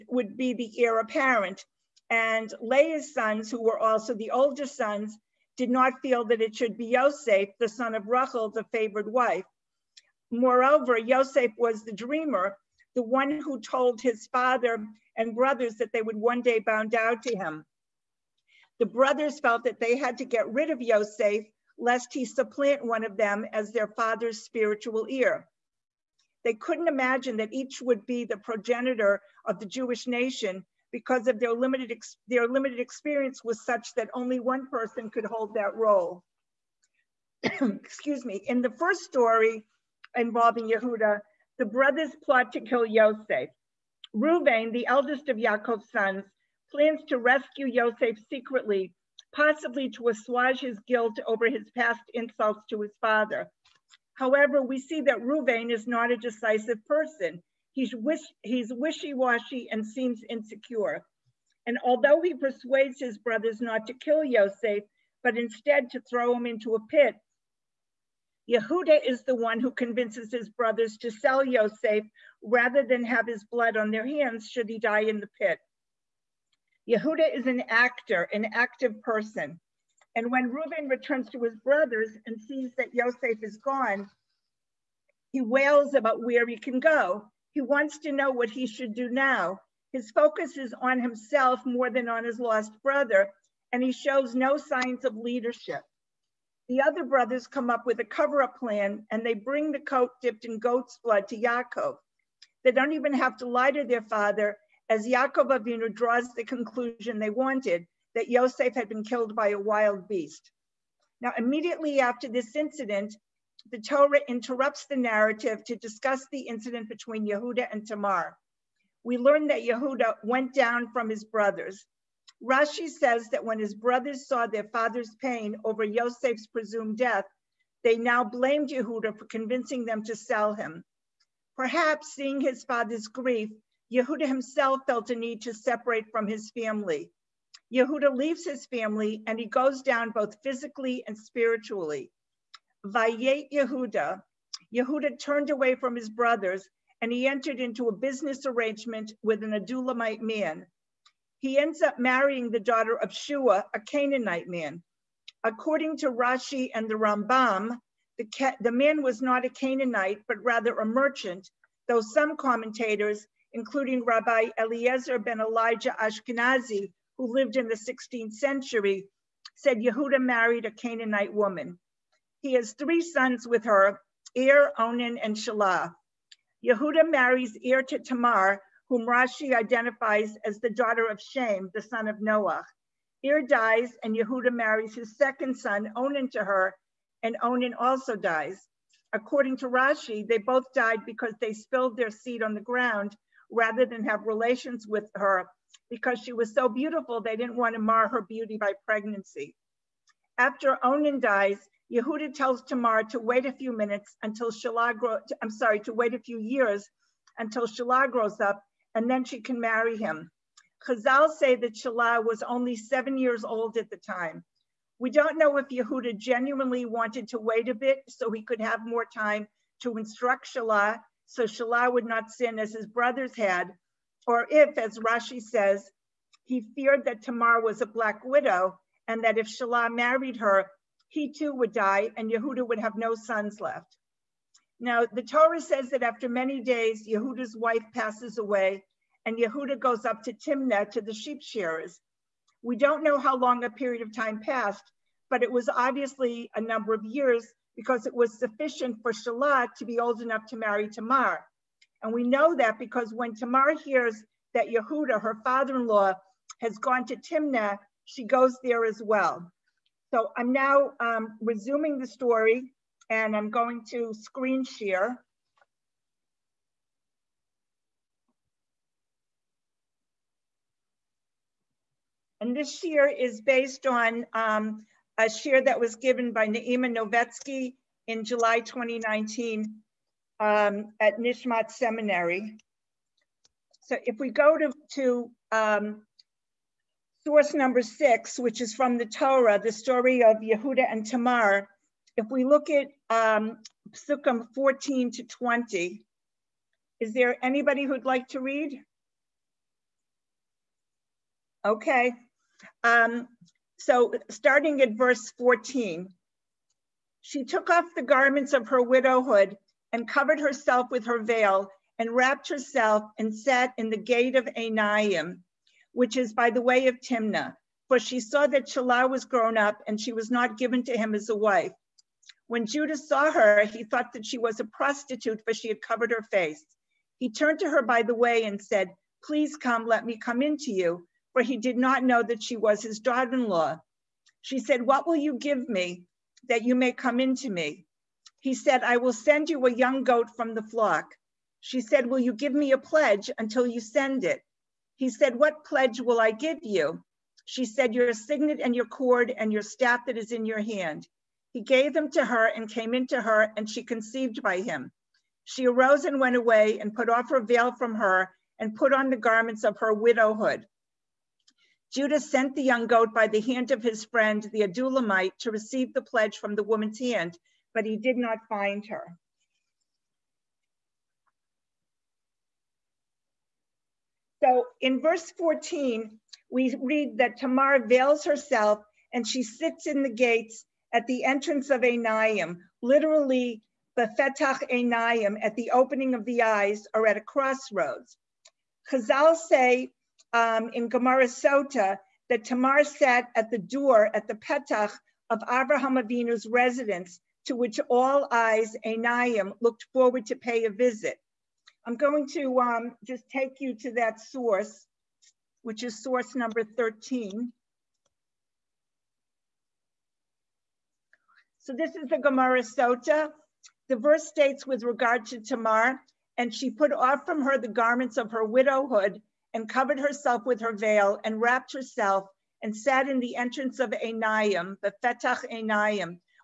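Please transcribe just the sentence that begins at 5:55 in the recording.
She arose and went away and put off her veil from her and put on the garments of her widowhood.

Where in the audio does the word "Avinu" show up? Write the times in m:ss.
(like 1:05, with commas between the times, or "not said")
1:45, 6:36.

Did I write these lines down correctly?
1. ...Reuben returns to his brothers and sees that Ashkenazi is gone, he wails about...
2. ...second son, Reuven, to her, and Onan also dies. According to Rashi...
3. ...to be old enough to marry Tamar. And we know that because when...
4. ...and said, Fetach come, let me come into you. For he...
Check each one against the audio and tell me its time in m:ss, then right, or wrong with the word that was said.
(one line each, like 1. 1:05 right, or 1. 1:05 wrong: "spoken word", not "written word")
1. 1:20 wrong: "Yosef", not "Ashkenazi"
2. 3:05 wrong: "Onan", not "Reuven"
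3. 4:09 right
4. 5:28 wrong: "Please", not "Fetach".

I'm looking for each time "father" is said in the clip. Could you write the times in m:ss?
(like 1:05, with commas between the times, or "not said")
0:14, 0:23, 0:52, 1:44, 2:04, 2:12, 4:15.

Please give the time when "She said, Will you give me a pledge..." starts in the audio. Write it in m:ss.
5:41.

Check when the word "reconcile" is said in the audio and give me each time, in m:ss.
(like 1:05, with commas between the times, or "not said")
not said.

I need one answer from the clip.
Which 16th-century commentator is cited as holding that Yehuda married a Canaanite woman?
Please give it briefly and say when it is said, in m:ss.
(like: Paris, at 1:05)
Rabbi Eliezer ben Elijah Ashkenazi, at 2:44.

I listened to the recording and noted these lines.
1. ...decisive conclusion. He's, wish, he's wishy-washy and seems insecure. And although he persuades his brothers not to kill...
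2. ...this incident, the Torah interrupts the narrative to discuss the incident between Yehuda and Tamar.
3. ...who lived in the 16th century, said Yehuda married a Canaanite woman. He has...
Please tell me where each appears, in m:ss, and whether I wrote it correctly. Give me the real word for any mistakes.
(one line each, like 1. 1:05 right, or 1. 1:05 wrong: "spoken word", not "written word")
1. 0:56 wrong: "person", not "conclusion"
2. 1:52 right
3. 2:47 right.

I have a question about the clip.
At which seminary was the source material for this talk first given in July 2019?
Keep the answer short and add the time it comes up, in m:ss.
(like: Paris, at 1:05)
Nishmat Seminary, at 4:41.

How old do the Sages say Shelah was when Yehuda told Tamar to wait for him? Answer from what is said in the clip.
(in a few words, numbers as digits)
7.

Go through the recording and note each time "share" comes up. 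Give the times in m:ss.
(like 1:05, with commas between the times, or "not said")
4:24, 4:35.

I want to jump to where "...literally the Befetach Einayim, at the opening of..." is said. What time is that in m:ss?
6:22.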